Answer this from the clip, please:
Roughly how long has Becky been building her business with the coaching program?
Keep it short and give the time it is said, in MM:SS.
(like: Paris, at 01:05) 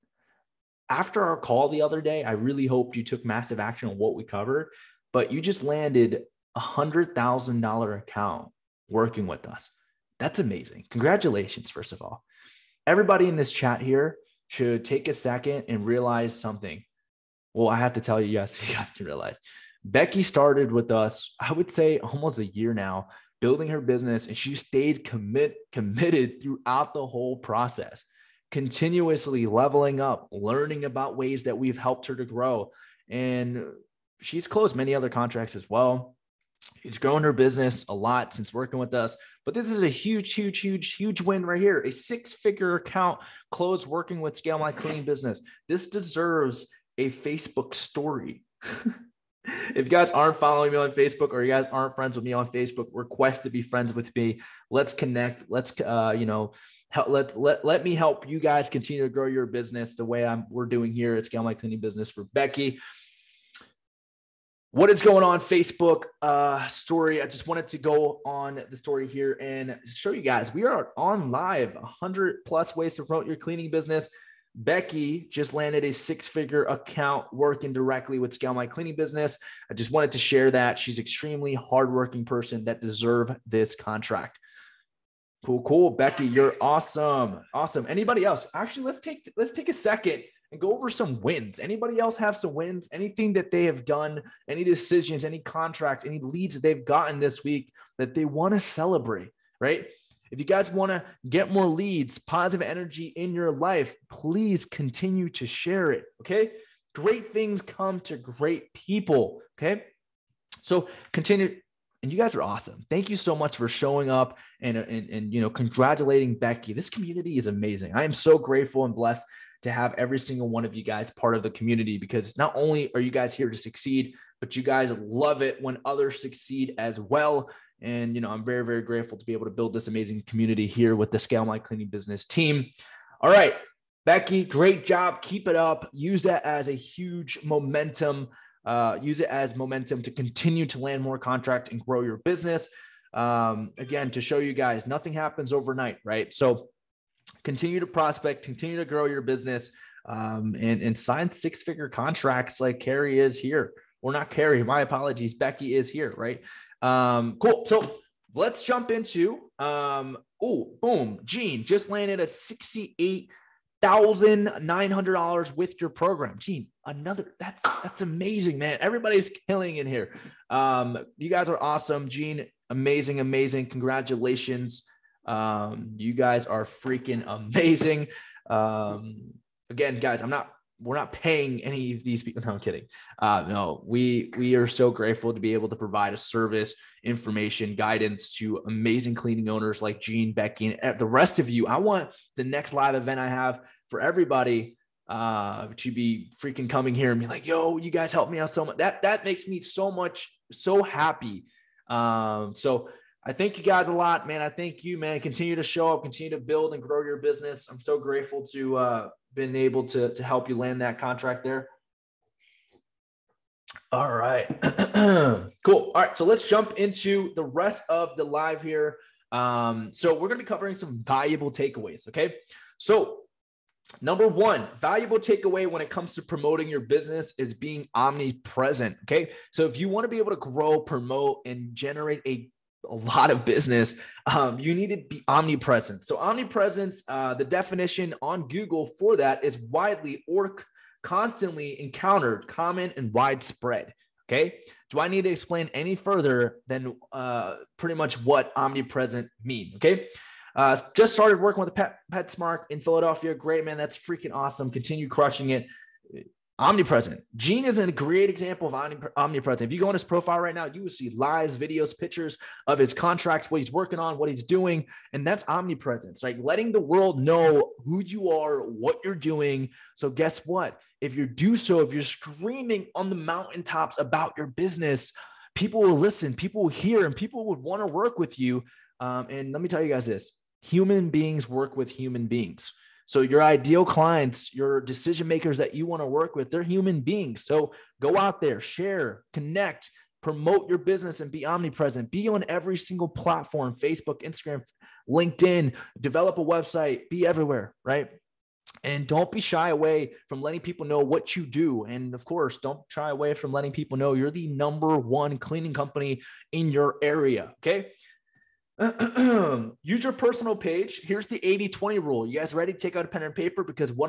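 almost a year, at 00:21.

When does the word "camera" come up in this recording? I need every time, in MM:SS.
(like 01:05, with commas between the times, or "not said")
not said.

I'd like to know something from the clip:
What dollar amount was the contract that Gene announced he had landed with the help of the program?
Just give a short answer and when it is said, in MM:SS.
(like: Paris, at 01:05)
$68,900, at 02:42.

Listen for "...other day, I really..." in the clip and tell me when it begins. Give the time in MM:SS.
00:01.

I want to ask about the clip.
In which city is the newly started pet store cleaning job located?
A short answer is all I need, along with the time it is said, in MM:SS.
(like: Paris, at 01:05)
Philadelphia, at 04:12.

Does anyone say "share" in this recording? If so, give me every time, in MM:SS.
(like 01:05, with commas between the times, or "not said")
01:20, 01:45, 04:48.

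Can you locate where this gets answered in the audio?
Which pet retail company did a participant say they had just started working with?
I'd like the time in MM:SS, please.
04:12.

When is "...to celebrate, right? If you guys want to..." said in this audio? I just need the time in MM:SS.
01:38.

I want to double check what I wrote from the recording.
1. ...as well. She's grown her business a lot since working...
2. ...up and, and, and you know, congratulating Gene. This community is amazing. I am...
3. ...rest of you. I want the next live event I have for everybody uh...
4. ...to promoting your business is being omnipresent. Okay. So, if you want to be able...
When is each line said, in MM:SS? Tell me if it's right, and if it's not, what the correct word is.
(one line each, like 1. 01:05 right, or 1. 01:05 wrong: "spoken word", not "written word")
1. 00:35 right
2. 01:54 wrong: "Becky", not "Gene"
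3. 03:11 right
4. 03:46 right.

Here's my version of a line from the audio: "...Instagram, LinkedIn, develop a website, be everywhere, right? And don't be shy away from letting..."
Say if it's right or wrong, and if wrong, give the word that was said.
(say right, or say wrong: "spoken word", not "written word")
right.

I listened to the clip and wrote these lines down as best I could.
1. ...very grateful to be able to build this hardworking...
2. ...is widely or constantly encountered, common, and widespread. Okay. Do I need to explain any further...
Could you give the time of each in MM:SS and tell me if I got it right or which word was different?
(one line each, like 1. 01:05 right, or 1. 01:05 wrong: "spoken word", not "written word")
1. 02:08 wrong: "amazing", not "hardworking"
2. 03:59 right.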